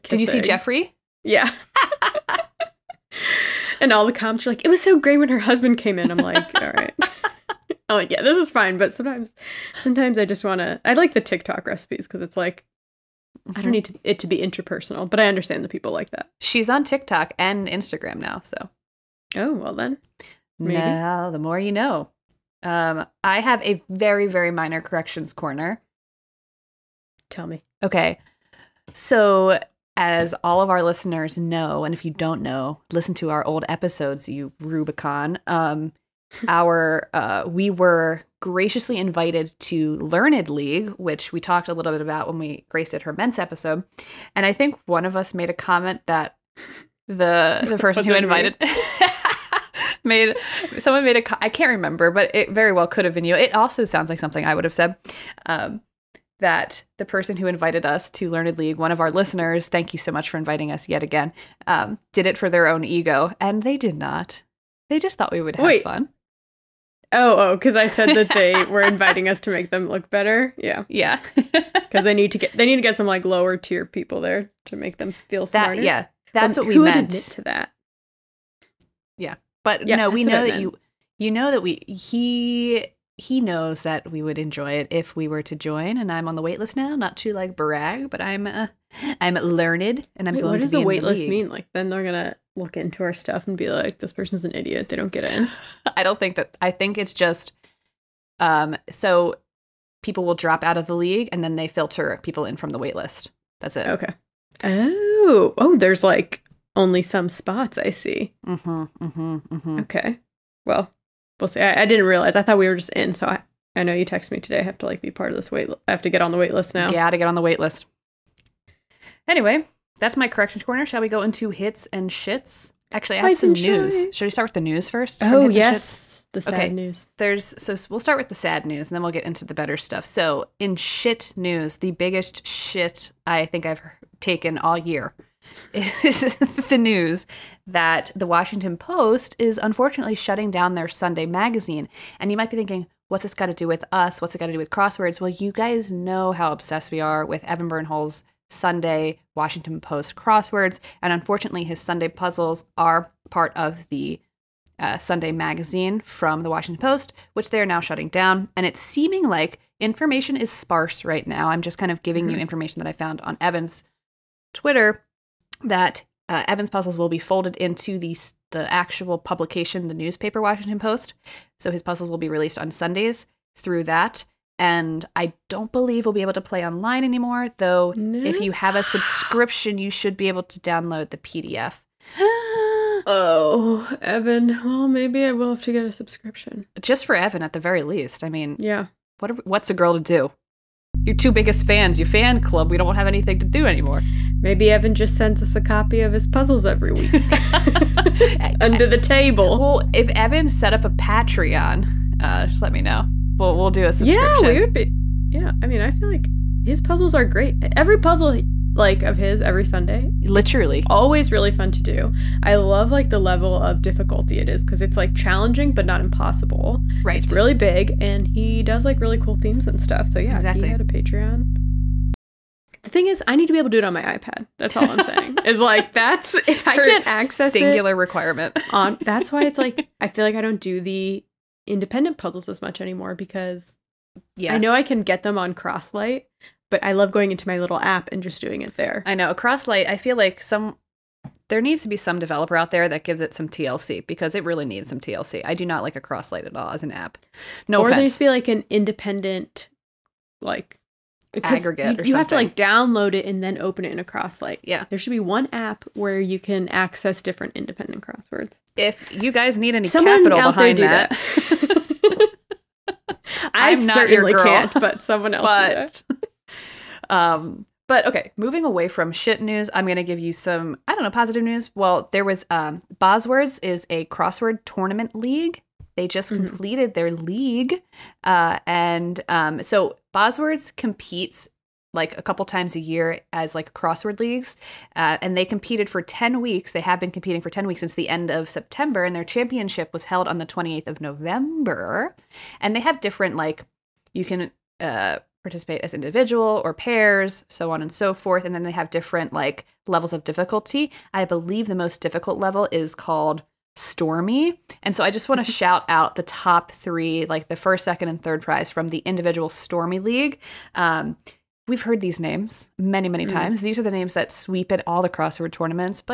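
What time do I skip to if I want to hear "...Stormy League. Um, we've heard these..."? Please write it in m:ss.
5:09.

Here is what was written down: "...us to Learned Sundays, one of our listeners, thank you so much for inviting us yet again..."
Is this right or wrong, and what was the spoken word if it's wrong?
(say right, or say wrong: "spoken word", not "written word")
wrong: "League", not "Sundays".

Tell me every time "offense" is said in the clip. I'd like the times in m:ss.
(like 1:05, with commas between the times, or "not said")
4:07.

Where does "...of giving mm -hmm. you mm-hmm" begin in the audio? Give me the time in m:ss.
2:41.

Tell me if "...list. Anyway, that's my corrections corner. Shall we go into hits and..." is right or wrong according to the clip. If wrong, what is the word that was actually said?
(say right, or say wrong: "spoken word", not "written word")
right.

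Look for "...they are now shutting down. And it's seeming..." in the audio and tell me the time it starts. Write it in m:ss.
2:37.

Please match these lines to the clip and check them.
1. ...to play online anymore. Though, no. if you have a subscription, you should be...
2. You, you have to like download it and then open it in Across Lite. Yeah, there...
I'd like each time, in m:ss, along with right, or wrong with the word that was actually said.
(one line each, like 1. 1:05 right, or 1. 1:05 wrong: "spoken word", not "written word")
1. 2:56 right
2. 4:11 right.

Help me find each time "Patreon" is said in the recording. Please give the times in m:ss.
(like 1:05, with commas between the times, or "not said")
3:20, 3:40.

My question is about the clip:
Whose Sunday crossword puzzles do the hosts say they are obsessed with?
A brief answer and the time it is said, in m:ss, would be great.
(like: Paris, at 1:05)
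Evan Birnholz, at 2:27.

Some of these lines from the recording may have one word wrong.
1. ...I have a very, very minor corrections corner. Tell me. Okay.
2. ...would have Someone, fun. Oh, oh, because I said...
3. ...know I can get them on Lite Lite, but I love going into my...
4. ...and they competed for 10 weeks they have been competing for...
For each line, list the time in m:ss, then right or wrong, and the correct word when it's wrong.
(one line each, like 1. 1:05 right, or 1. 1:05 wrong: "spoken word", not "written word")
1. 0:23 right
2. 1:05 wrong: "Wait", not "Someone"
3. 3:54 wrong: "Across", not "Lite"
4. 4:45 right.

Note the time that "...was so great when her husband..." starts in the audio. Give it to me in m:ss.
0:04.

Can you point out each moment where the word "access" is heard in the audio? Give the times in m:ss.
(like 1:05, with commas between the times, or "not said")
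3:47, 4:16.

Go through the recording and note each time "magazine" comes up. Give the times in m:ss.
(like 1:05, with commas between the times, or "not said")
2:21, 2:35.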